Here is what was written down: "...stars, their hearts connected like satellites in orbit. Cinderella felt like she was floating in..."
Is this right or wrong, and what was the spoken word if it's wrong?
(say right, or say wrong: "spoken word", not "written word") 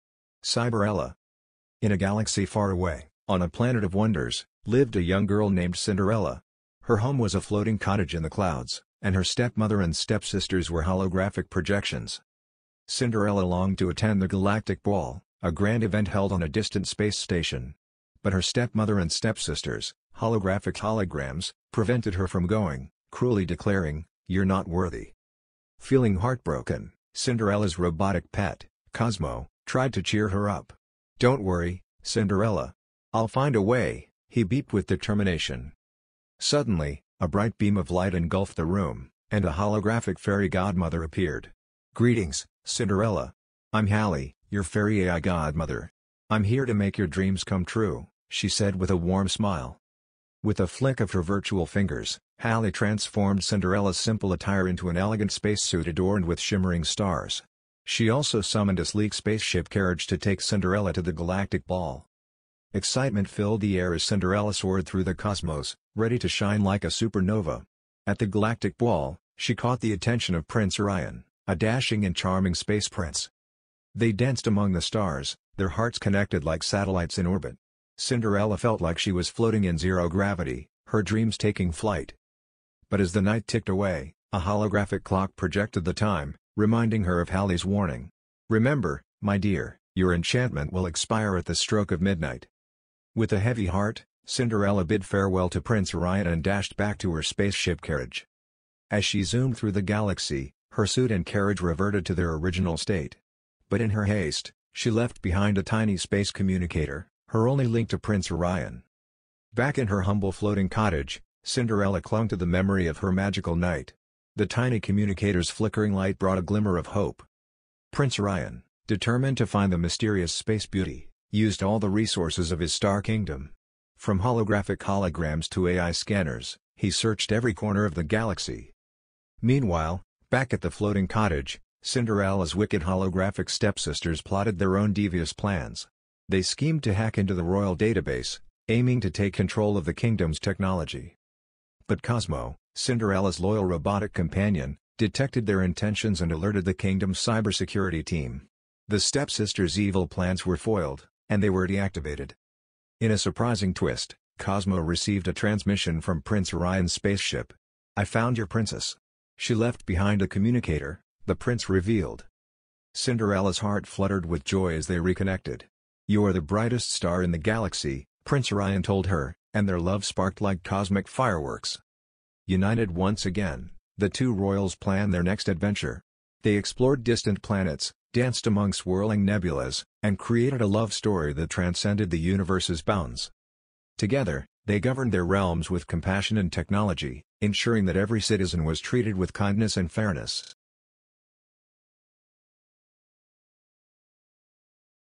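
right.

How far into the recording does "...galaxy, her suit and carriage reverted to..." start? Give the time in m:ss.
1:39.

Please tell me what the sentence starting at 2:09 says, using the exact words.
Meanwhile, back at the floating cottage, Cinderella's wicked holographic stepsisters plotted their own devious plans.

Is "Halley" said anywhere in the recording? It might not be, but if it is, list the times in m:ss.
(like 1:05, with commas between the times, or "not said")
0:43, 0:52, 1:27.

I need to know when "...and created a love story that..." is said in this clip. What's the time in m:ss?
3:00.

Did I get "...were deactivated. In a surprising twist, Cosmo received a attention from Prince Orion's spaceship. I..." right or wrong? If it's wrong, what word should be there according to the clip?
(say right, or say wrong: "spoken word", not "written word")
wrong: "transmission", not "attention".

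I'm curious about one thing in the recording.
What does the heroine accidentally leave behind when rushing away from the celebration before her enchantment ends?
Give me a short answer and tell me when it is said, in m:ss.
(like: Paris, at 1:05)
space communicator, at 1:45.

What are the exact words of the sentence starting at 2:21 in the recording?
But Cosmo, Cinderella's loyal robotic companion, detected their intentions and alerted the kingdom's cybersecurity team.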